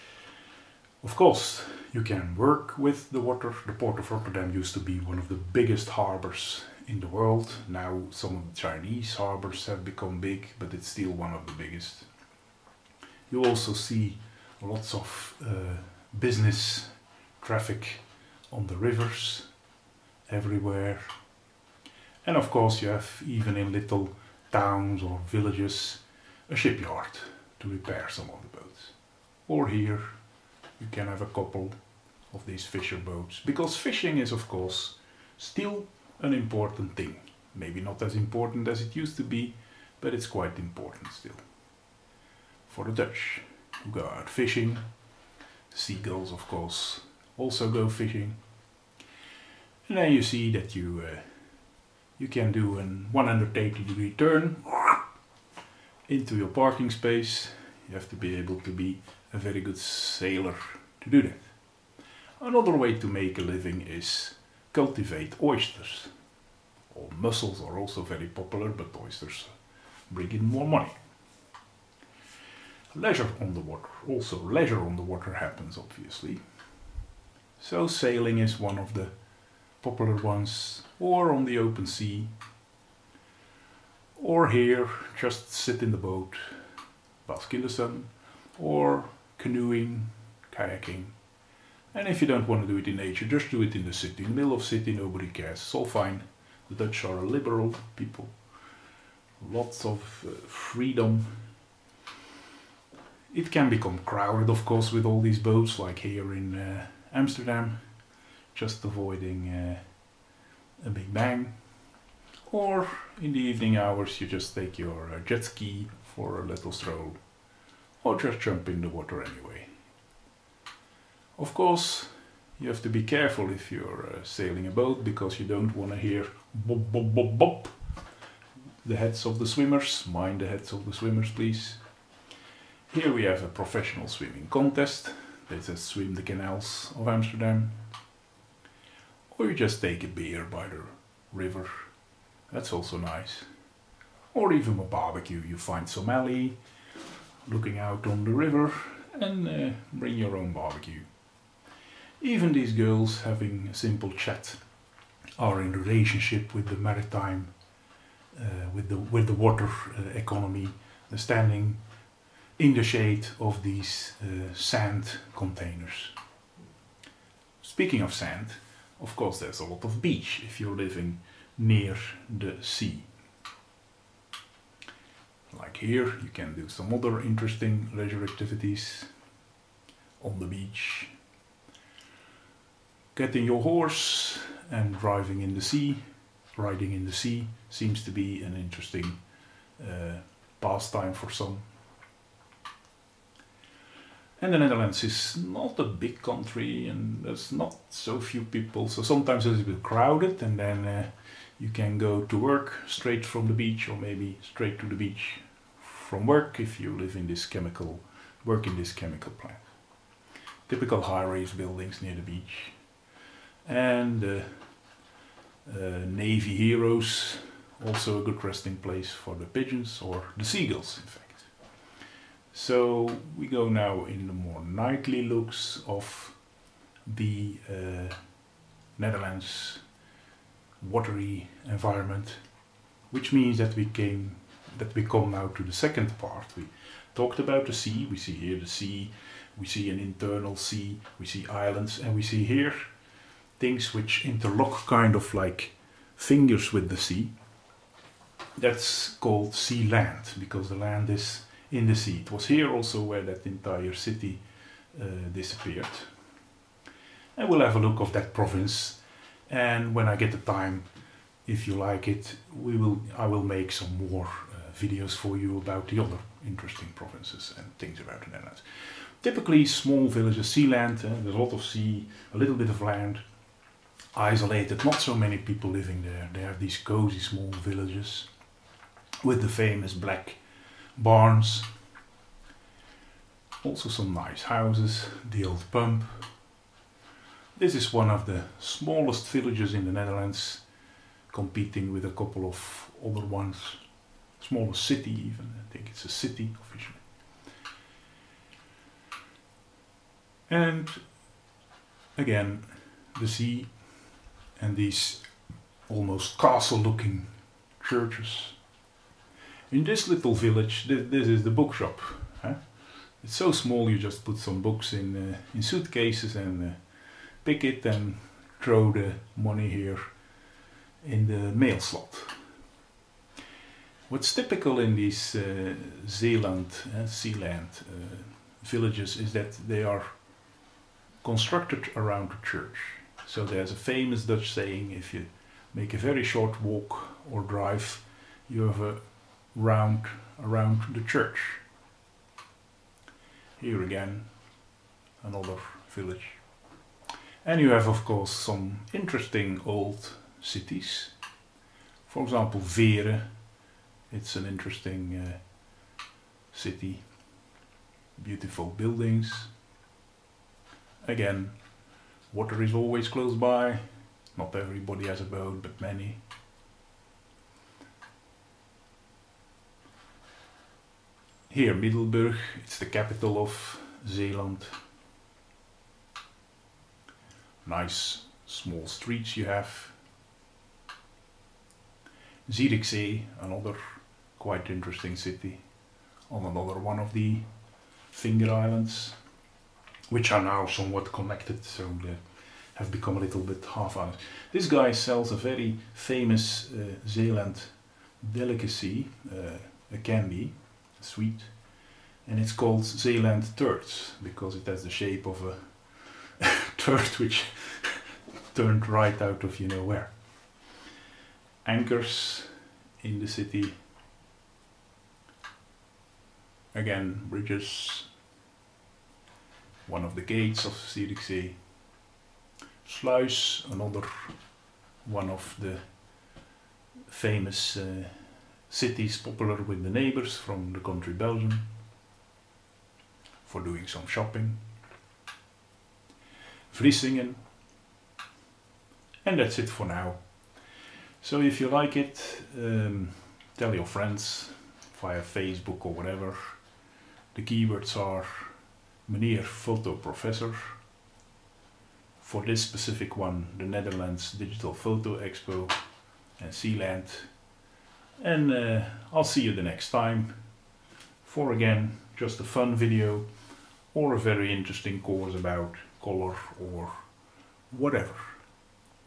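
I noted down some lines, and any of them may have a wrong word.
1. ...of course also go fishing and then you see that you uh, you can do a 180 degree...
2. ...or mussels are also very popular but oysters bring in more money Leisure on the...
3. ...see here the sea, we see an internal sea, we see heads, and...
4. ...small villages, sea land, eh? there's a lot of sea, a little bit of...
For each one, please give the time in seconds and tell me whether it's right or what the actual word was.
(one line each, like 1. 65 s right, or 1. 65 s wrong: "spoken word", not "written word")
1. 46 s right
2. 66 s right
3. 238 s wrong: "islands", not "heads"
4. 269 s right.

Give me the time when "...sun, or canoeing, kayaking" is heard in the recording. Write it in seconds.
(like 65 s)
87 s.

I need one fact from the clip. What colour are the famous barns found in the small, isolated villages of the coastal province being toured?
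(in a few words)
Black.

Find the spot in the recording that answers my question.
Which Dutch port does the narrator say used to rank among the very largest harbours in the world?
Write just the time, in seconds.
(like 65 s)
4 s.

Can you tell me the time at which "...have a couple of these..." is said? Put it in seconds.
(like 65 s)
31 s.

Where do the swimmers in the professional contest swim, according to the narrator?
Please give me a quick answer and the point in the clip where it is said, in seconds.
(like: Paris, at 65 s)
The canals of Amsterdam, at 136 s.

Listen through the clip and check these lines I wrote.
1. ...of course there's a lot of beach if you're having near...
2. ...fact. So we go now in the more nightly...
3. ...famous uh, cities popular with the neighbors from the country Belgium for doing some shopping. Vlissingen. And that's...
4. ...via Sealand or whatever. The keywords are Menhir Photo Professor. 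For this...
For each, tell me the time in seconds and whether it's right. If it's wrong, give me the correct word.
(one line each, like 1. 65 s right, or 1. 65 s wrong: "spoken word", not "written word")
1. 169 s wrong: "living", not "having"
2. 221 s right
3. 427 s right
4. 445 s wrong: "Facebook", not "Sealand".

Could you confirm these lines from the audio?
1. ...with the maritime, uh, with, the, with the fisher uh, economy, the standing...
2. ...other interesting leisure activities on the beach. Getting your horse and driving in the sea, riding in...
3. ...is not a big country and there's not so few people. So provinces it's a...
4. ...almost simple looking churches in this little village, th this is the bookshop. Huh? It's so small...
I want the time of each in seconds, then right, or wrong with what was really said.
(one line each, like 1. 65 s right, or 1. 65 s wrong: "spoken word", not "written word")
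1. 156 s wrong: "water", not "fisher"
2. 176 s right
3. 195 s wrong: "sometimes", not "provinces"
4. 305 s wrong: "castle", not "simple".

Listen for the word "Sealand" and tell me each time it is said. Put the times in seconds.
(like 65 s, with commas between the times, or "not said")
327 s, 456 s.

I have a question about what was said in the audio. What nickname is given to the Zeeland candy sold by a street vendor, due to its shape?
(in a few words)
Zeeland Turds.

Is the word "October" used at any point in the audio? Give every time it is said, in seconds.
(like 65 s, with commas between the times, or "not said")
not said.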